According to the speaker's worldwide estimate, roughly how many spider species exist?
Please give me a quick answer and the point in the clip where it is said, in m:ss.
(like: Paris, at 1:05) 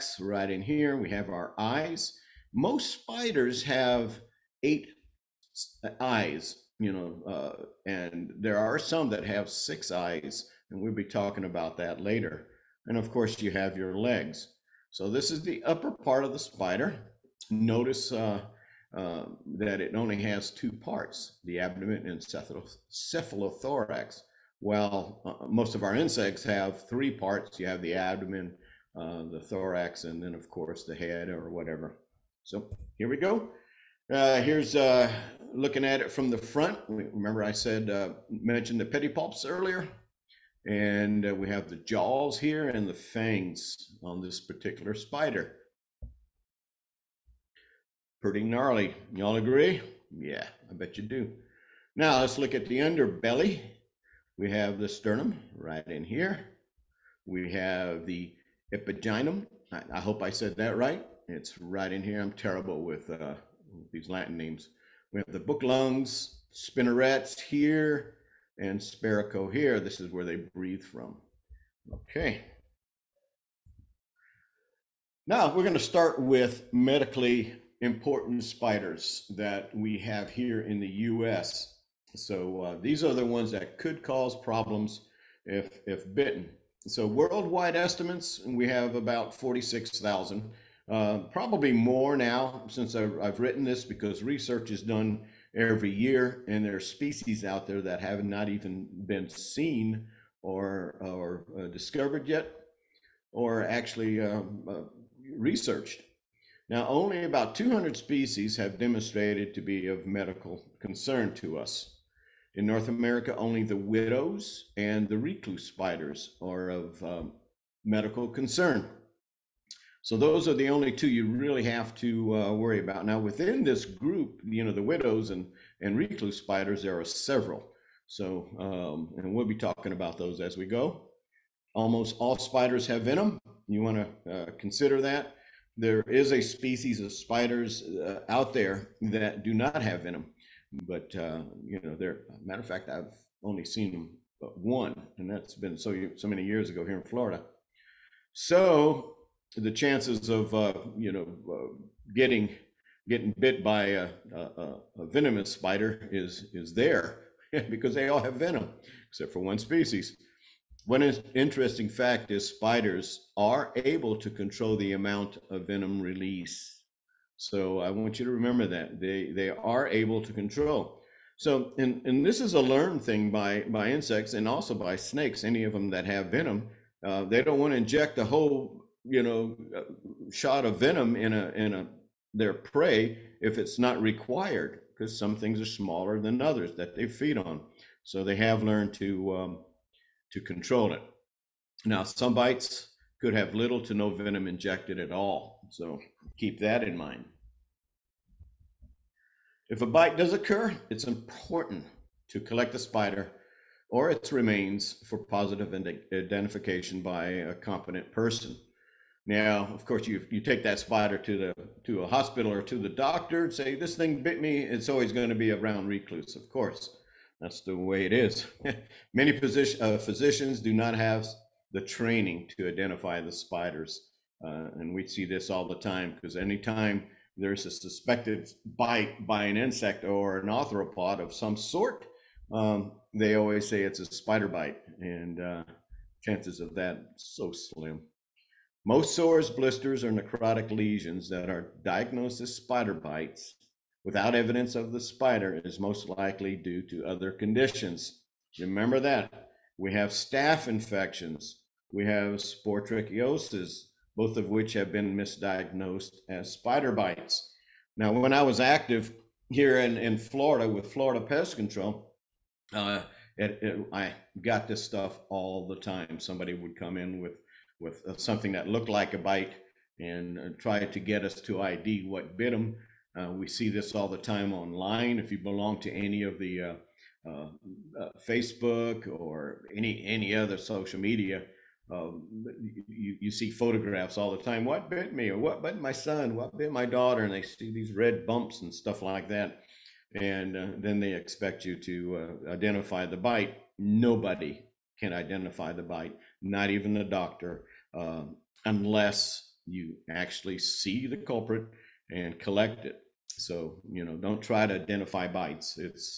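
46,000, at 1:29.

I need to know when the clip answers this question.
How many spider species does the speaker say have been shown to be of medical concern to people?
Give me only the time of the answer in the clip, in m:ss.
1:47.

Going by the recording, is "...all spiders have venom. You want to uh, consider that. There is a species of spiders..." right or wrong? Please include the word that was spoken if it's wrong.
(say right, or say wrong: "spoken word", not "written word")
right.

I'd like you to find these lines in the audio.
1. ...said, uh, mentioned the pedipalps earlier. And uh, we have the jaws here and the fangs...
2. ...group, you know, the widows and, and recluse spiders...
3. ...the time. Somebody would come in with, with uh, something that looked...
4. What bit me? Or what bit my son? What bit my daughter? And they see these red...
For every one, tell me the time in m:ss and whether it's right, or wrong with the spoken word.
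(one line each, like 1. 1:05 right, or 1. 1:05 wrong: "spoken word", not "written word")
1. 0:37 right
2. 2:03 right
3. 4:25 right
4. 4:44 right.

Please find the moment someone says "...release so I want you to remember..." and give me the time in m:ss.
2:46.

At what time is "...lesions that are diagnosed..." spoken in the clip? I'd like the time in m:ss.
4:00.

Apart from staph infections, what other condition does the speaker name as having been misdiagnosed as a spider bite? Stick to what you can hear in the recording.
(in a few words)
sporotrichosis.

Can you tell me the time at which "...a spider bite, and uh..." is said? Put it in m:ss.
3:53.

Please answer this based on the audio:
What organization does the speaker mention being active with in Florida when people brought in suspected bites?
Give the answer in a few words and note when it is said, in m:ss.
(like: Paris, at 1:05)
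Florida Pest Control, at 4:20.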